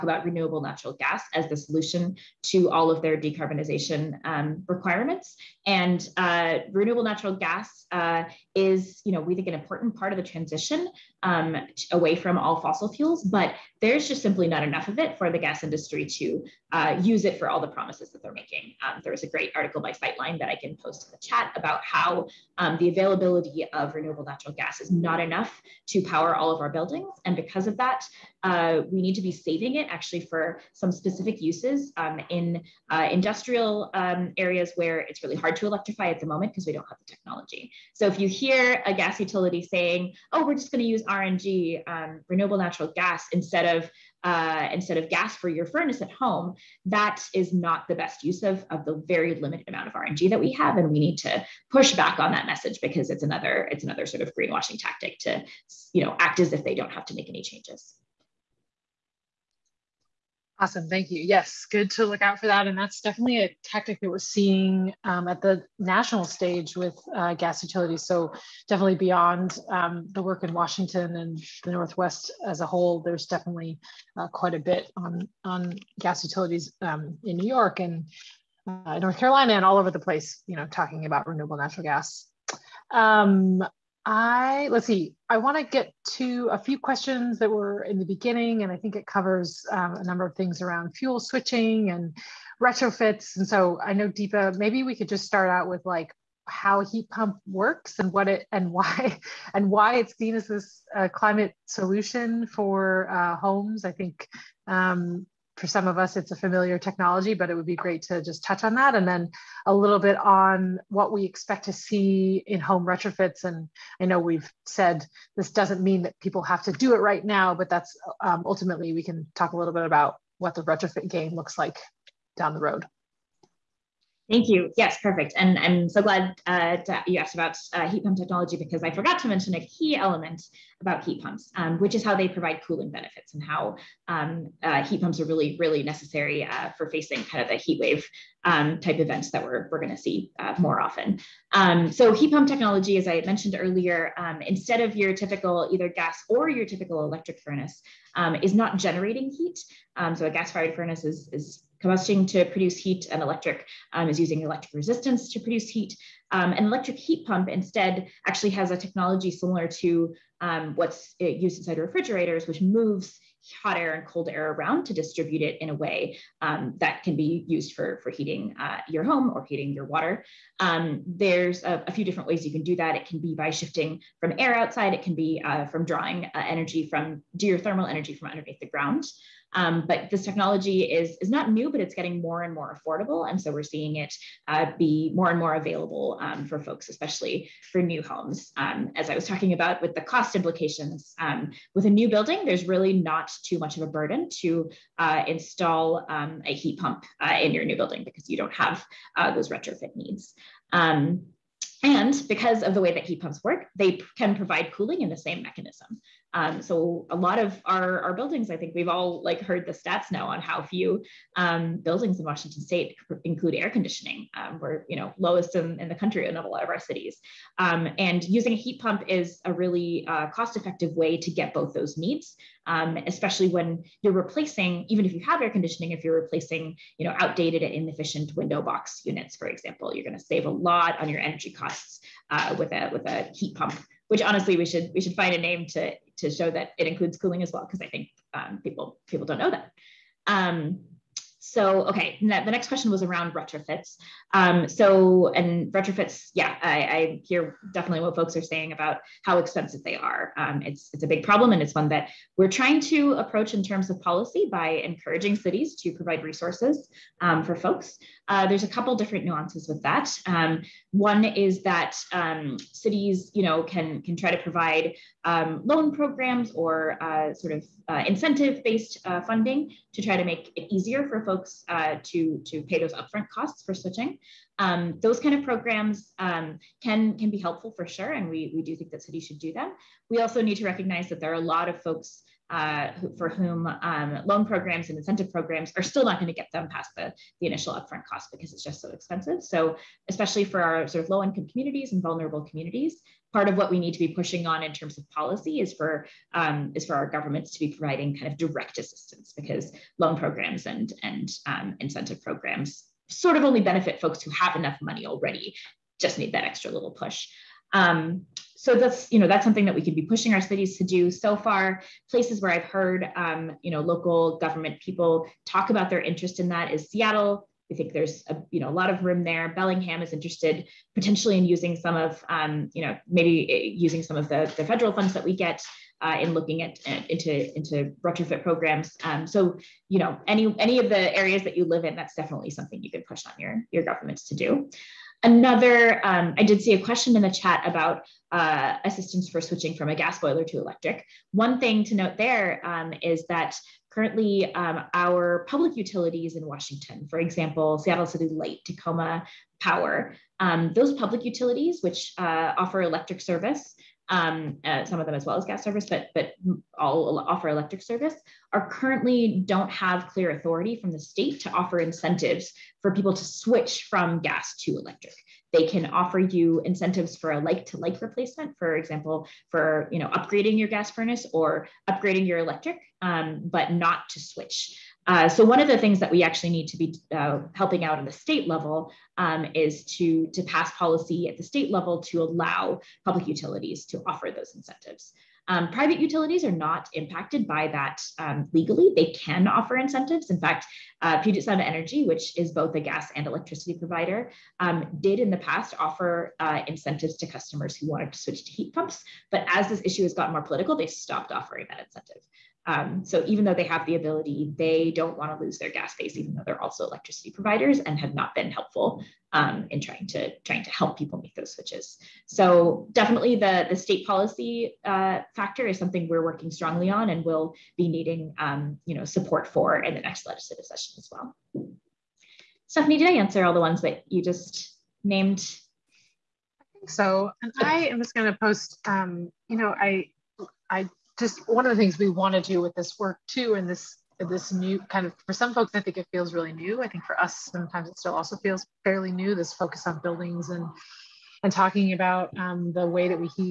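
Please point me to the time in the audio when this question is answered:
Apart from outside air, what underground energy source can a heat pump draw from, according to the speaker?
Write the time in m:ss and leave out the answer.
2:57.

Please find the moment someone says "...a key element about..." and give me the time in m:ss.
2:09.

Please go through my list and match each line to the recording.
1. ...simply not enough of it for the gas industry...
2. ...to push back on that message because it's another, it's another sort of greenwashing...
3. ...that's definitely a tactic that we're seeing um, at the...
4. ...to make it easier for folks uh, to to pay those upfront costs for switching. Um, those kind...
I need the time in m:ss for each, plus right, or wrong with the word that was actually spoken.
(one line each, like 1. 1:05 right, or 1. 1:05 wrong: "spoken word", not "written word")
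1. 0:14 right
2. 0:51 right
3. 1:02 right
4. 4:30 right.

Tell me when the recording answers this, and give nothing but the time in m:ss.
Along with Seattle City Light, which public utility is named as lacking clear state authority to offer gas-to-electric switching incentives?
5:48.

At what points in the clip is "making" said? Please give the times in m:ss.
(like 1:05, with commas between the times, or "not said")
0:18.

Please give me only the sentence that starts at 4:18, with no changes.
Uh, there's a couple different nuances with that.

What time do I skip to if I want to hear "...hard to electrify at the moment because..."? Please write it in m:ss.
0:35.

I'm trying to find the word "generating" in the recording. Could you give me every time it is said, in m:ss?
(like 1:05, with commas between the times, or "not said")
2:28.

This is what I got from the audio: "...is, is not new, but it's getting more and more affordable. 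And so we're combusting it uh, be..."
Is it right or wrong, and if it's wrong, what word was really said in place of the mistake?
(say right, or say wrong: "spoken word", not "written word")
wrong: "seeing", not "combusting".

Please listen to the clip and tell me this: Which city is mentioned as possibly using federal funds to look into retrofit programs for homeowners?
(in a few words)
Bellingham.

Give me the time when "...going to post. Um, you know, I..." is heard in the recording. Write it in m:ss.
7:08.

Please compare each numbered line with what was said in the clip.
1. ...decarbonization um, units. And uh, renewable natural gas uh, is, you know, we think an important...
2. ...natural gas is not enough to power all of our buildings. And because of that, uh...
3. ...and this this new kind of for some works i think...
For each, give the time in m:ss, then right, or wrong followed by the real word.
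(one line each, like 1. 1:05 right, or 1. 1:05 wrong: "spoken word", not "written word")
1. 0:03 wrong: "requirements", not "units"
2. 0:24 right
3. 7:13 wrong: "folks", not "works".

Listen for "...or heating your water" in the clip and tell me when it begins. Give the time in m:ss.
2:49.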